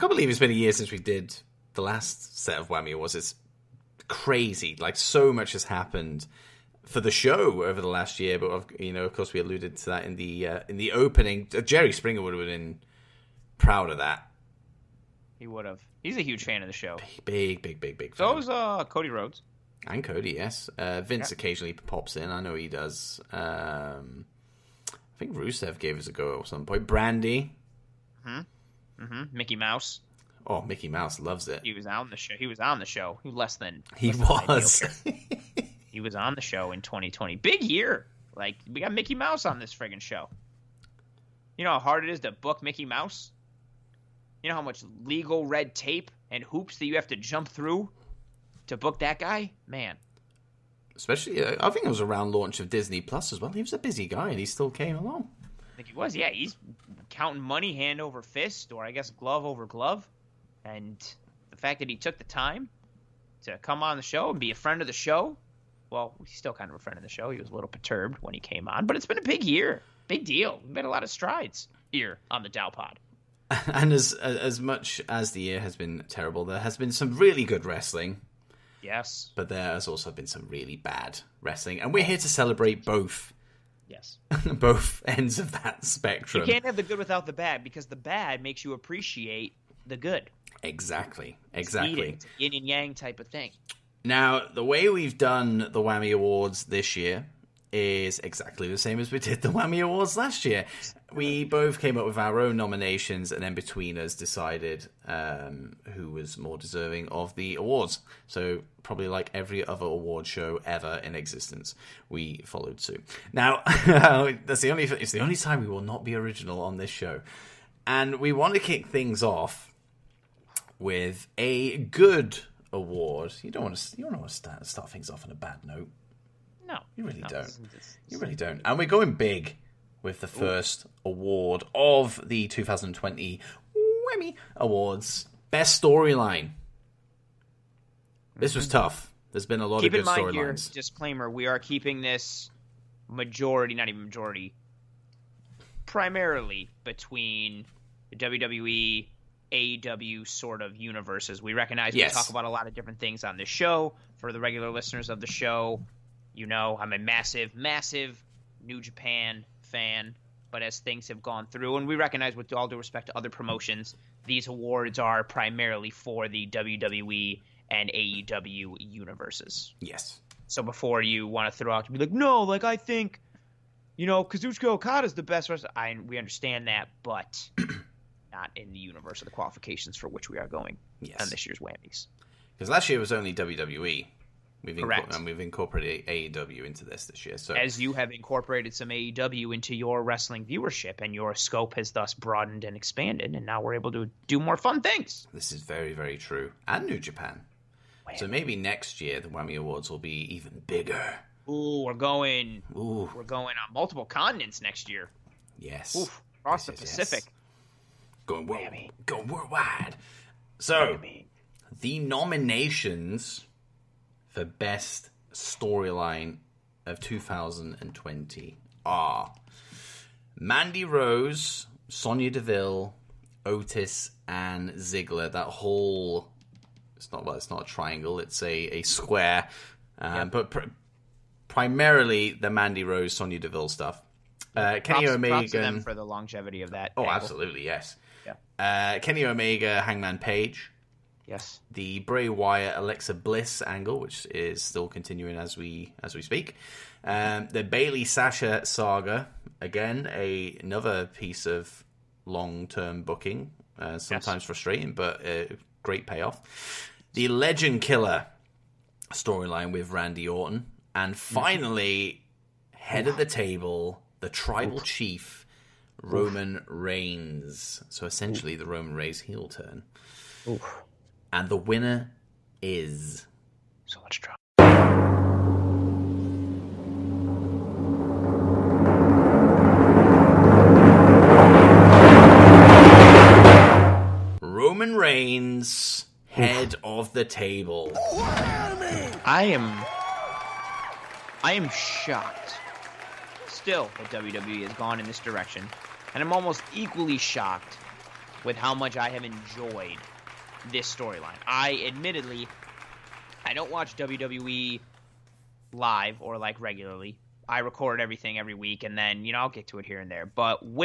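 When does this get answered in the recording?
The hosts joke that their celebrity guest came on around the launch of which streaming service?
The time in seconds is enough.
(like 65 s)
52 s.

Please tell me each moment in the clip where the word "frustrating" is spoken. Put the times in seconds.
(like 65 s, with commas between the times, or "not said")
254 s.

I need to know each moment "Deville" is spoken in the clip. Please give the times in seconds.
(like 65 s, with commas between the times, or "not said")
222 s, 233 s.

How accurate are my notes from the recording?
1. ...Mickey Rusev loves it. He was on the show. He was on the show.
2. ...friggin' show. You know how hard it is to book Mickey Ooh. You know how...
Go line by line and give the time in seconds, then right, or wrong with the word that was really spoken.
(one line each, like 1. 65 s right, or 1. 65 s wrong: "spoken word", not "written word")
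1. 30 s wrong: "Mouse", not "Rusev"
2. 39 s wrong: "Mouse", not "Ooh".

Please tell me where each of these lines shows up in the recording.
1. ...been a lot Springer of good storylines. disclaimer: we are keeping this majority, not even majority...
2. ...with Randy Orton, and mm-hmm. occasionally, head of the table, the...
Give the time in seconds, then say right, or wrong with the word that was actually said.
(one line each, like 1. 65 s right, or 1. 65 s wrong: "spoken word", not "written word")
1. 139 s wrong: "Keep", not "Springer"
2. 259 s wrong: "finally", not "occasionally".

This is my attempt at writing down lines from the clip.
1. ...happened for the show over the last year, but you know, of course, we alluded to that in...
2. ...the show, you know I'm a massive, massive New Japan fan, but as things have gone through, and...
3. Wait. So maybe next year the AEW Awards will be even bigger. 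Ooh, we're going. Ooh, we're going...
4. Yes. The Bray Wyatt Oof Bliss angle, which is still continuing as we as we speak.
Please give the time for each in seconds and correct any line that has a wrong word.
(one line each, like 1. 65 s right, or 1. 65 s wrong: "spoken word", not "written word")
1. 5 s right
2. 155 s right
3. 198 s wrong: "Whammy", not "AEW"
4. 241 s wrong: "Alexa", not "Oof".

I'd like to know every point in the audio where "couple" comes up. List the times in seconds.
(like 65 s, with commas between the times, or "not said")
not said.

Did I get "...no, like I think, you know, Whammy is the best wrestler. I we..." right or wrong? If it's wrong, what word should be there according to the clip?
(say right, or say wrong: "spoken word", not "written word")
wrong: "Kazuchika", not "Whammy".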